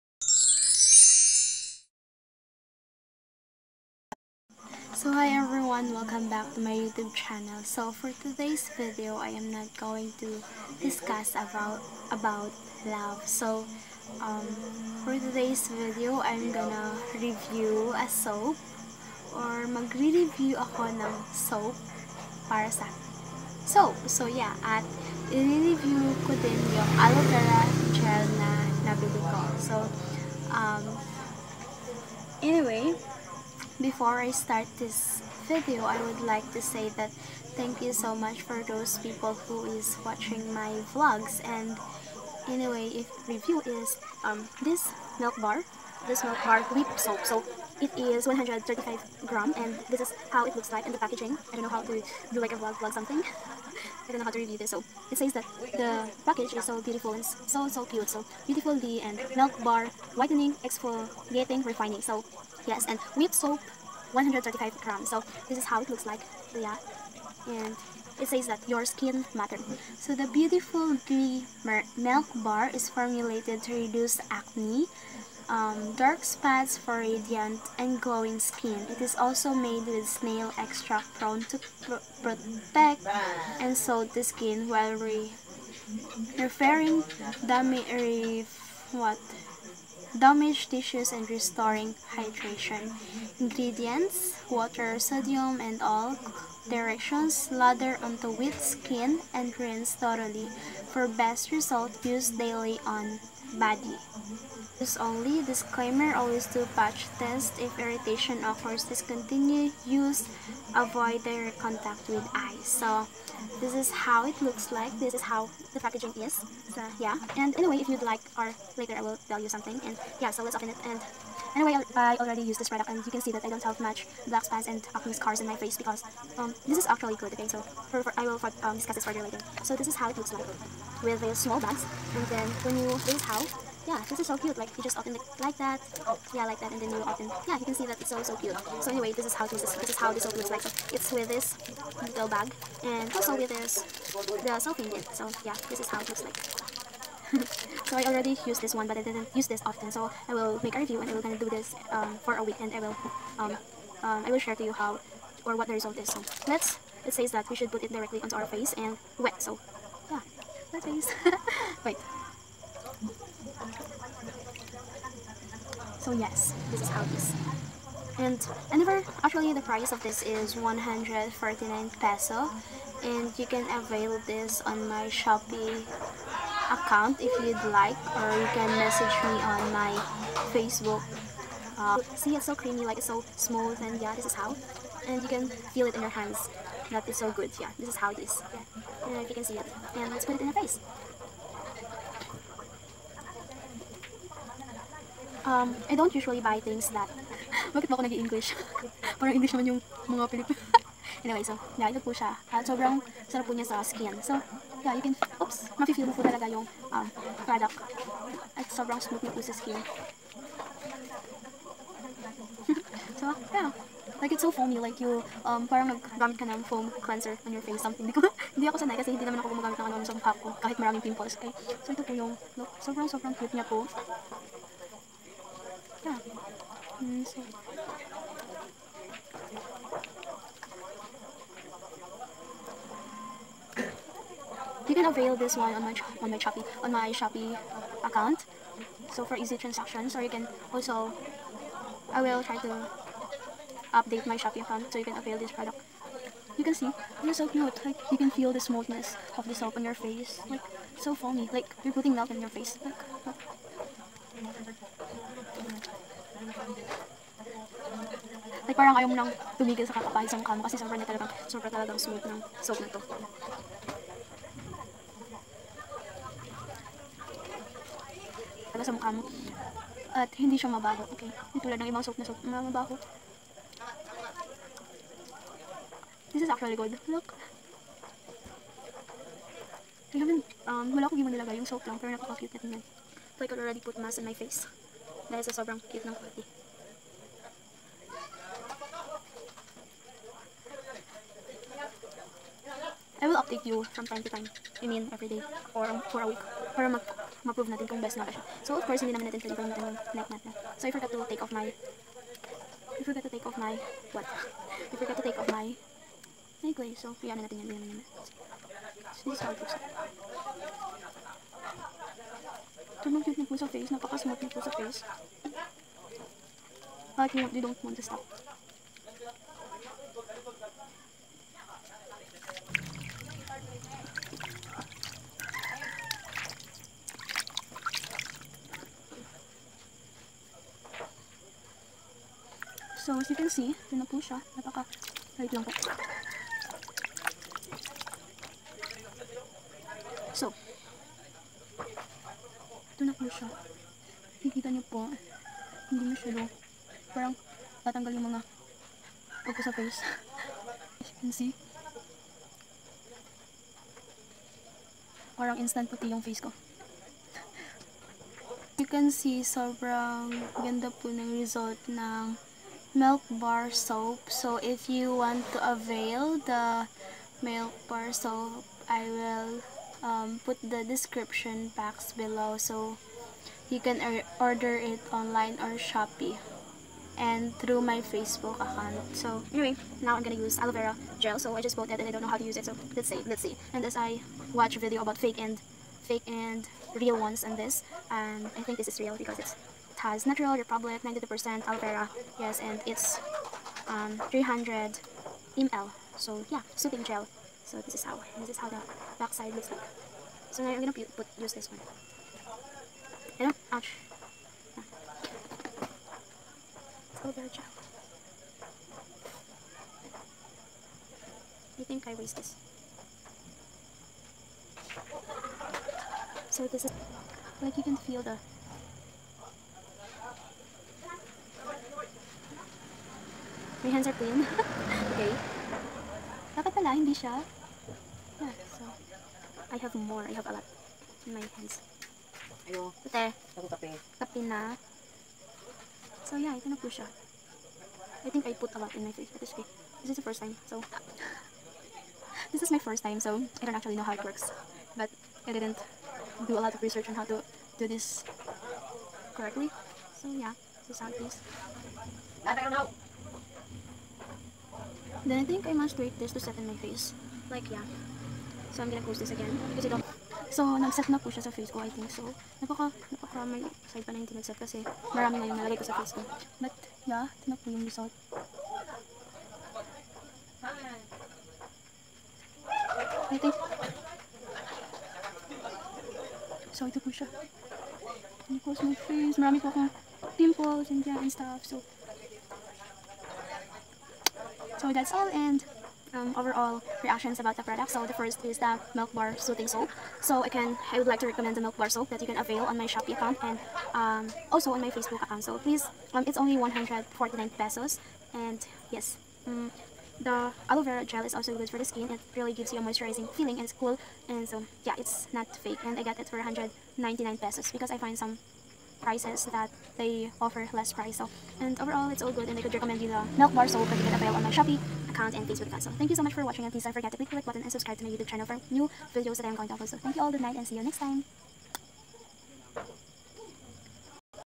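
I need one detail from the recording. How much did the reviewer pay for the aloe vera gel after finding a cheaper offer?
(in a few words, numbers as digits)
199 pesos.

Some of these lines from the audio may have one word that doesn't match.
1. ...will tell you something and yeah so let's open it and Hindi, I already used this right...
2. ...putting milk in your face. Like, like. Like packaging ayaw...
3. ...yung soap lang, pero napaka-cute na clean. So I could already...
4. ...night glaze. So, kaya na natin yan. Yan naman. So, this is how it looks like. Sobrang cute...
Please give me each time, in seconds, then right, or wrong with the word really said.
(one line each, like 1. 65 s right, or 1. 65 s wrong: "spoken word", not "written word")
1. 119 s wrong: "Anyway", not "Hindi"
2. 251 s wrong: "parang", not "packaging"
3. 281 s wrong: "tingnan", not "clean"
4. 306 s right.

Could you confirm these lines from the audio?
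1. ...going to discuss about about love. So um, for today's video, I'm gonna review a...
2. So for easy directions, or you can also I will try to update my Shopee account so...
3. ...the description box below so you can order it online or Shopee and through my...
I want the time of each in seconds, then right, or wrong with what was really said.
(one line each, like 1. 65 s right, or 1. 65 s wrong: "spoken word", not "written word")
1. 9 s right
2. 239 s wrong: "transactions", not "directions"
3. 370 s right.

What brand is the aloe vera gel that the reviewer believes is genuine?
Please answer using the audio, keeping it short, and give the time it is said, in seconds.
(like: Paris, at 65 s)
Natural Republic, at 390 s.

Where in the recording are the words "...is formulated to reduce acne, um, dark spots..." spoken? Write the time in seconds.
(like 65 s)
72 s.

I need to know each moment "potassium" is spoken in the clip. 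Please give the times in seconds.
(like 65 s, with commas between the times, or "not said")
not said.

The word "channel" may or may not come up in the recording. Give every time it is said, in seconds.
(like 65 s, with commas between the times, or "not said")
7 s, 518 s.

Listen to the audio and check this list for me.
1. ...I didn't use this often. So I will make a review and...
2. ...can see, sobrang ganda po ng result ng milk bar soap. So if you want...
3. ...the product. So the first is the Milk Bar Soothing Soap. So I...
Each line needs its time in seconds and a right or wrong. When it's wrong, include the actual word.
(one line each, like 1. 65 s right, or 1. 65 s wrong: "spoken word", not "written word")
1. 148 s right
2. 358 s right
3. 487 s right.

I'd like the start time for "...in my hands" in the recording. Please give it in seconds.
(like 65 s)
431 s.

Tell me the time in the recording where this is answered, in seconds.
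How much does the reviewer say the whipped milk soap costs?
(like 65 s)
170 s.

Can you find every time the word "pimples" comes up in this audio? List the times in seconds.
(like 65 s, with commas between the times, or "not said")
221 s, 480 s.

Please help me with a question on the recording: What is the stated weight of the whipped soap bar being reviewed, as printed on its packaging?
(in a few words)
135 grams.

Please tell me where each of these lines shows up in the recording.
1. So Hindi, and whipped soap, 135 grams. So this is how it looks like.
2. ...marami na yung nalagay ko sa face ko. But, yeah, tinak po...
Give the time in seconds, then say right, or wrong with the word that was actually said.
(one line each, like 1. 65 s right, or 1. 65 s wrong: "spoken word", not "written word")
1. 62 s wrong: "Yes", not "Hindi"
2. 465 s right.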